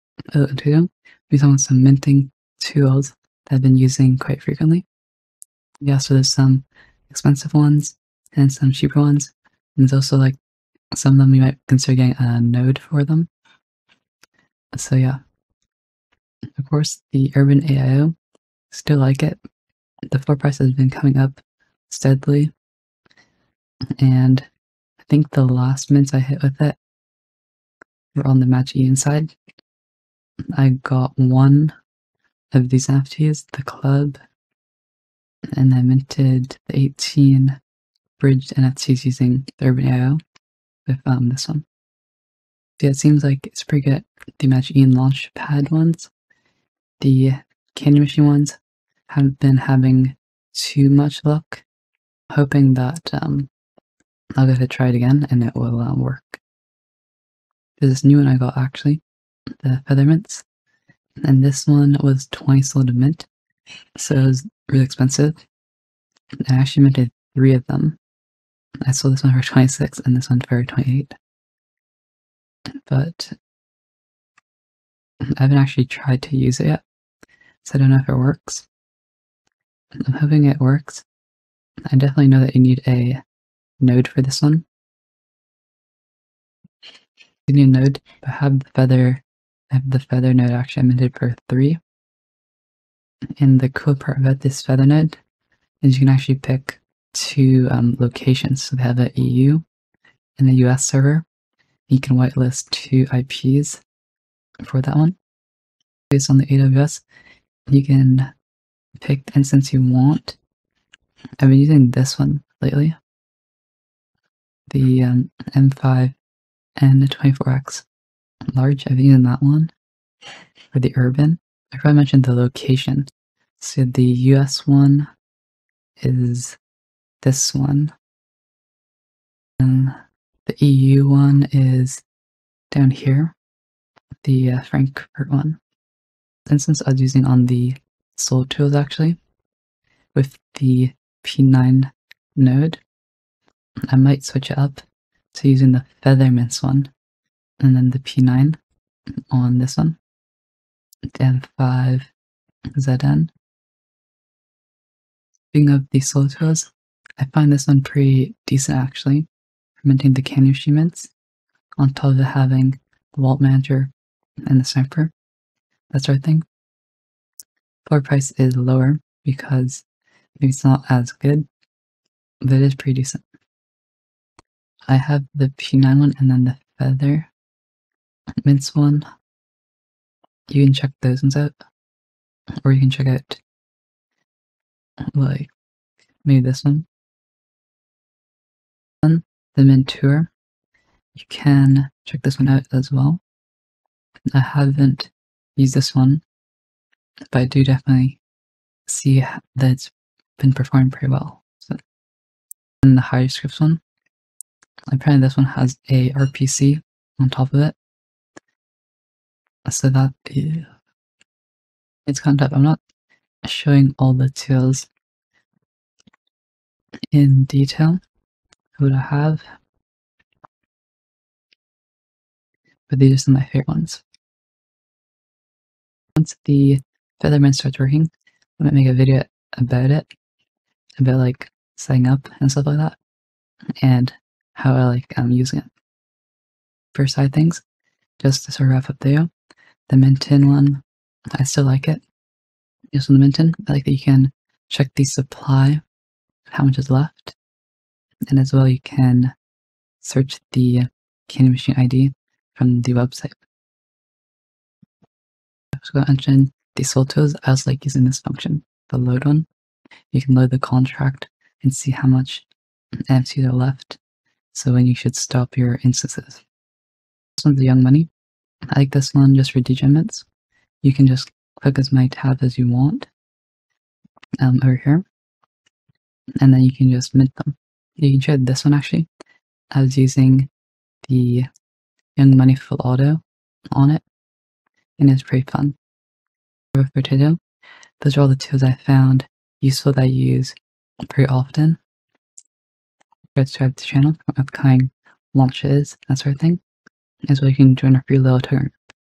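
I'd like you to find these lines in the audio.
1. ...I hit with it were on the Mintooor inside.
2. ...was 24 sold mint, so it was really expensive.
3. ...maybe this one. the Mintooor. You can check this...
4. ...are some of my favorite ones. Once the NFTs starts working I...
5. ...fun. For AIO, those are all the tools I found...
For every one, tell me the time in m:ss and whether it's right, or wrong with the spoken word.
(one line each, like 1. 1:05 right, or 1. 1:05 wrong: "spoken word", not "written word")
1. 0:26 wrong: "Match", not "Mintooor"
2. 1:02 wrong: "20", not "24"
3. 3:06 right
4. 3:43 wrong: "Featherman", not "NFTs"
5. 4:45 wrong: "Tido", not "AIO".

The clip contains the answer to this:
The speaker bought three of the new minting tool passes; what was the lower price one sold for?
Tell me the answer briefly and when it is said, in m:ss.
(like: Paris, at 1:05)
26, at 1:09.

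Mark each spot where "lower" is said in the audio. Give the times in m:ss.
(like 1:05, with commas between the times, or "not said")
2:48.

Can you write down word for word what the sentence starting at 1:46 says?
Based on the AWS, you can pick the instance you want.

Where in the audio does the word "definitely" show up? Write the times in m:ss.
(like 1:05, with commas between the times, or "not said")
1:21, 3:17.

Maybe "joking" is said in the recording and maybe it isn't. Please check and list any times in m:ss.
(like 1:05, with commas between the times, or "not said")
not said.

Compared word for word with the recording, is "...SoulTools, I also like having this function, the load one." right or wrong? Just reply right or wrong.
wrong.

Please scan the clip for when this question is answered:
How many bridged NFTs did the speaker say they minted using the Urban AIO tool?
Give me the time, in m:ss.
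0:36.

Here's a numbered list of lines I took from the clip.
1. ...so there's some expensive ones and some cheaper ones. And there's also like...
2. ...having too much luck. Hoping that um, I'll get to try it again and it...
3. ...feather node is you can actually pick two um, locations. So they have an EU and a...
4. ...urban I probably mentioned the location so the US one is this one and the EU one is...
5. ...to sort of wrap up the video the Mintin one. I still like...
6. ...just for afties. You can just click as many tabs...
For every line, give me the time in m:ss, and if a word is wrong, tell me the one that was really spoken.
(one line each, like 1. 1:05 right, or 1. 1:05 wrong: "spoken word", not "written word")
1. 0:05 right
2. 0:49 right
3. 1:34 right
4. 2:00 right
5. 3:58 right
6. 4:29 wrong: "degenerates", not "afties".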